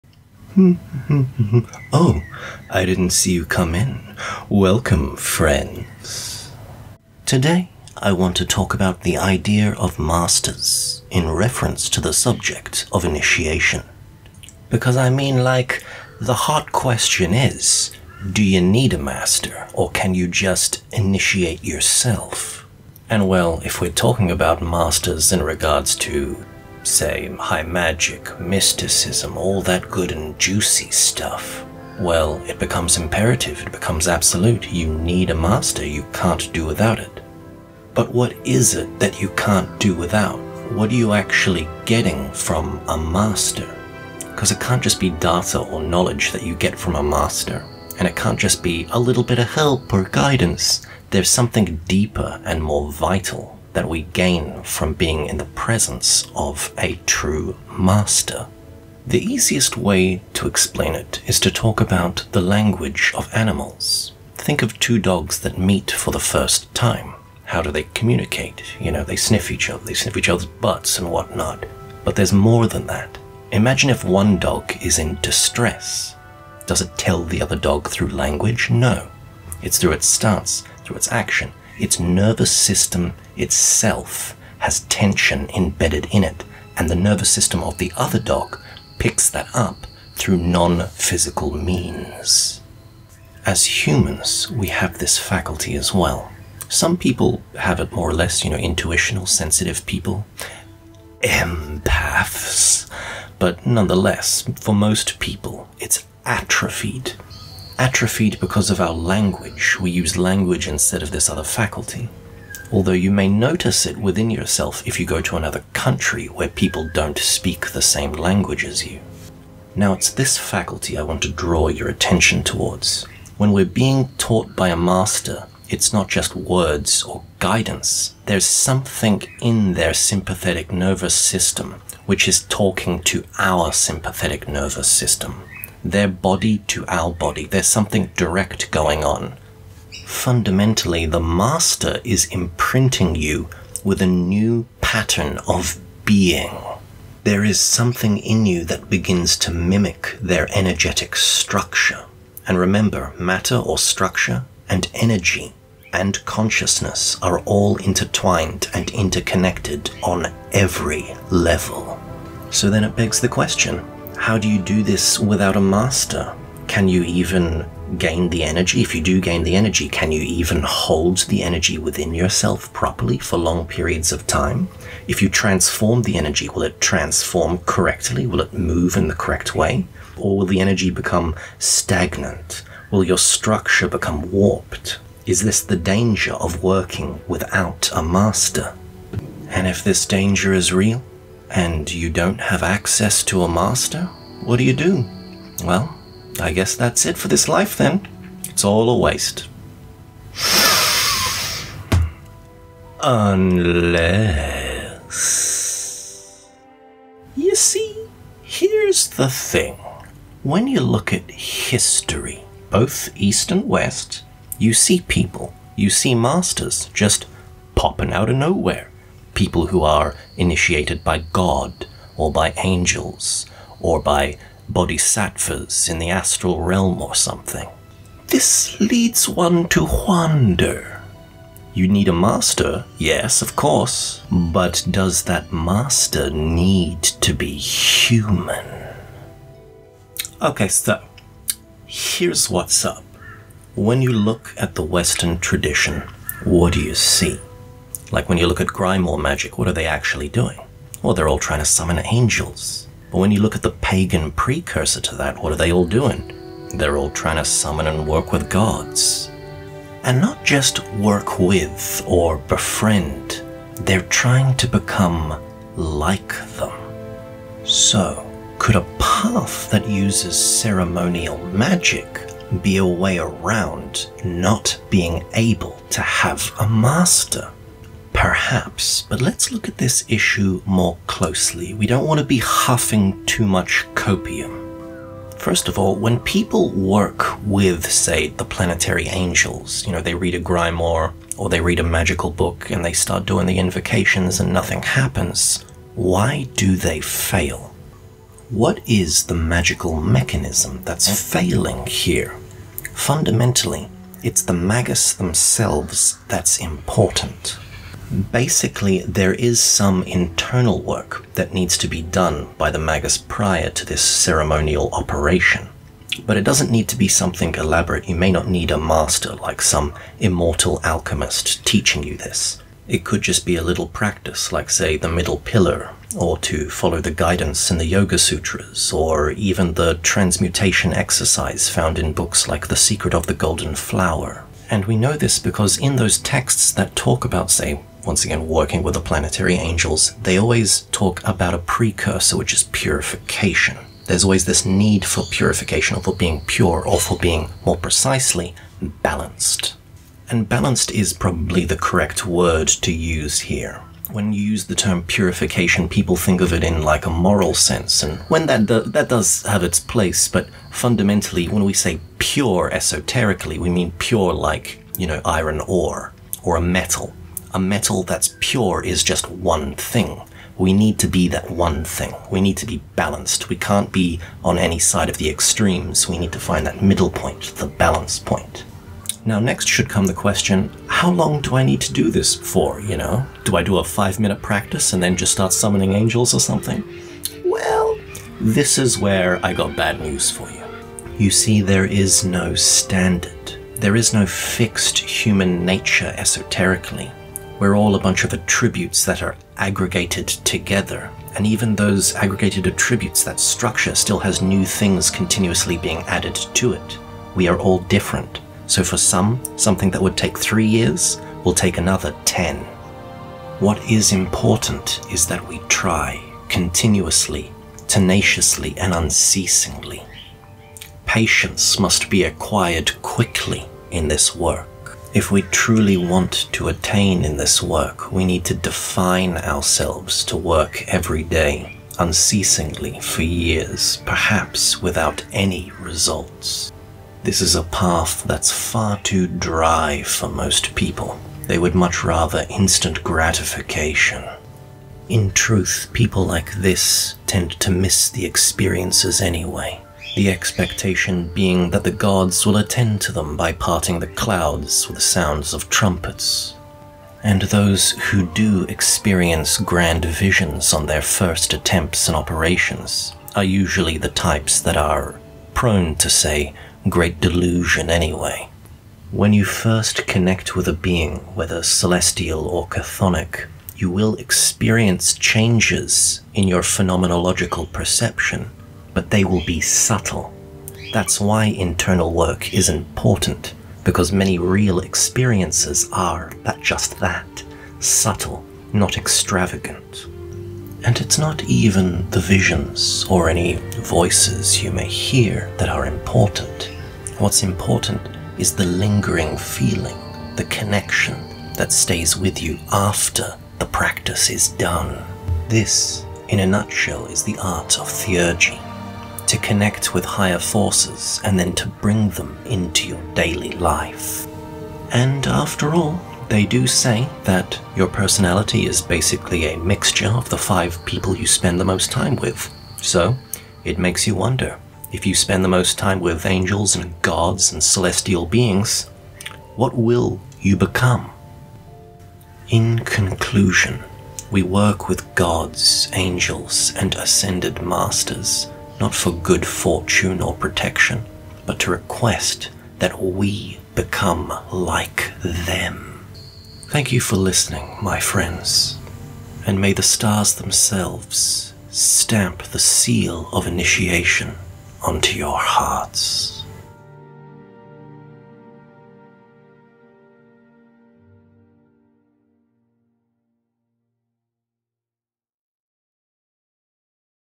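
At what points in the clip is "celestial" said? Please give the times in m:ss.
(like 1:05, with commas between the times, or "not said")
7:51, 8:47.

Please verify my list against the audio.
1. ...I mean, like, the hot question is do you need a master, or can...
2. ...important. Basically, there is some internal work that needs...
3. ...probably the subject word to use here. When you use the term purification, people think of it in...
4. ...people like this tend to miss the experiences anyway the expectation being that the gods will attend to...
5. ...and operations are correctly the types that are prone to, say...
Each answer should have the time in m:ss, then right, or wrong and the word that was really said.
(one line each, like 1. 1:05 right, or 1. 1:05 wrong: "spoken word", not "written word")
1. 0:14 right
2. 5:06 right
3. 5:51 wrong: "correct", not "subject"
4. 7:25 right
5. 7:42 wrong: "usually", not "correctly".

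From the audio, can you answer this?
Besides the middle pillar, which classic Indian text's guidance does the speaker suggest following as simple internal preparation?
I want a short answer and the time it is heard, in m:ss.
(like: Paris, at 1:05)
the Yoga Sutras, at 5:27.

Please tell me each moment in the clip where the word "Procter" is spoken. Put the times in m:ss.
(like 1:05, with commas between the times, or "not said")
not said.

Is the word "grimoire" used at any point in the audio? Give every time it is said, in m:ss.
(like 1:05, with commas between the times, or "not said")
4:08, 4:50.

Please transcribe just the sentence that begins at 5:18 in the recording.
You may not need a master like some immortal alchemist teaching you this.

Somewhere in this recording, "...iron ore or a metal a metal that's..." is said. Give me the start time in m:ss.
6:05.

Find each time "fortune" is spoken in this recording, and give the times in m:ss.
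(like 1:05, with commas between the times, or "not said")
8:59.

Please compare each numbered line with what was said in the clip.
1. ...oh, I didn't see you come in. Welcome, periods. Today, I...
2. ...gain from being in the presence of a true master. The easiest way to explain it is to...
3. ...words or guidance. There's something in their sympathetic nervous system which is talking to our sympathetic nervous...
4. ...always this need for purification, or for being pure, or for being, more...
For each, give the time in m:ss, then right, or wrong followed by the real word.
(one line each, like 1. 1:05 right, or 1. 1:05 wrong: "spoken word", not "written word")
1. 0:01 wrong: "friends", not "periods"
2. 0:54 right
3. 2:06 right
4. 5:44 right.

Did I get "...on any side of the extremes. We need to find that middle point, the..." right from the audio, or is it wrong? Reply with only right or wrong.
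right.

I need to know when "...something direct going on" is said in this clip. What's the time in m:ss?
2:17.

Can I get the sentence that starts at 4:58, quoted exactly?
What is the magical mechanism that's failing here?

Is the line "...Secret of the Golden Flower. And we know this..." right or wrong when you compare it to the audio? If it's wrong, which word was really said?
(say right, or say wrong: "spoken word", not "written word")
right.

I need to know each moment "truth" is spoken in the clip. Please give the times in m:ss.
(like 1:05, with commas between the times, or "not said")
7:25.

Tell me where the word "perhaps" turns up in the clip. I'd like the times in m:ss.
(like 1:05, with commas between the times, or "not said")
4:38, 7:14.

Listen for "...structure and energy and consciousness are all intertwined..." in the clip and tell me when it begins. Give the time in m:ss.
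2:33.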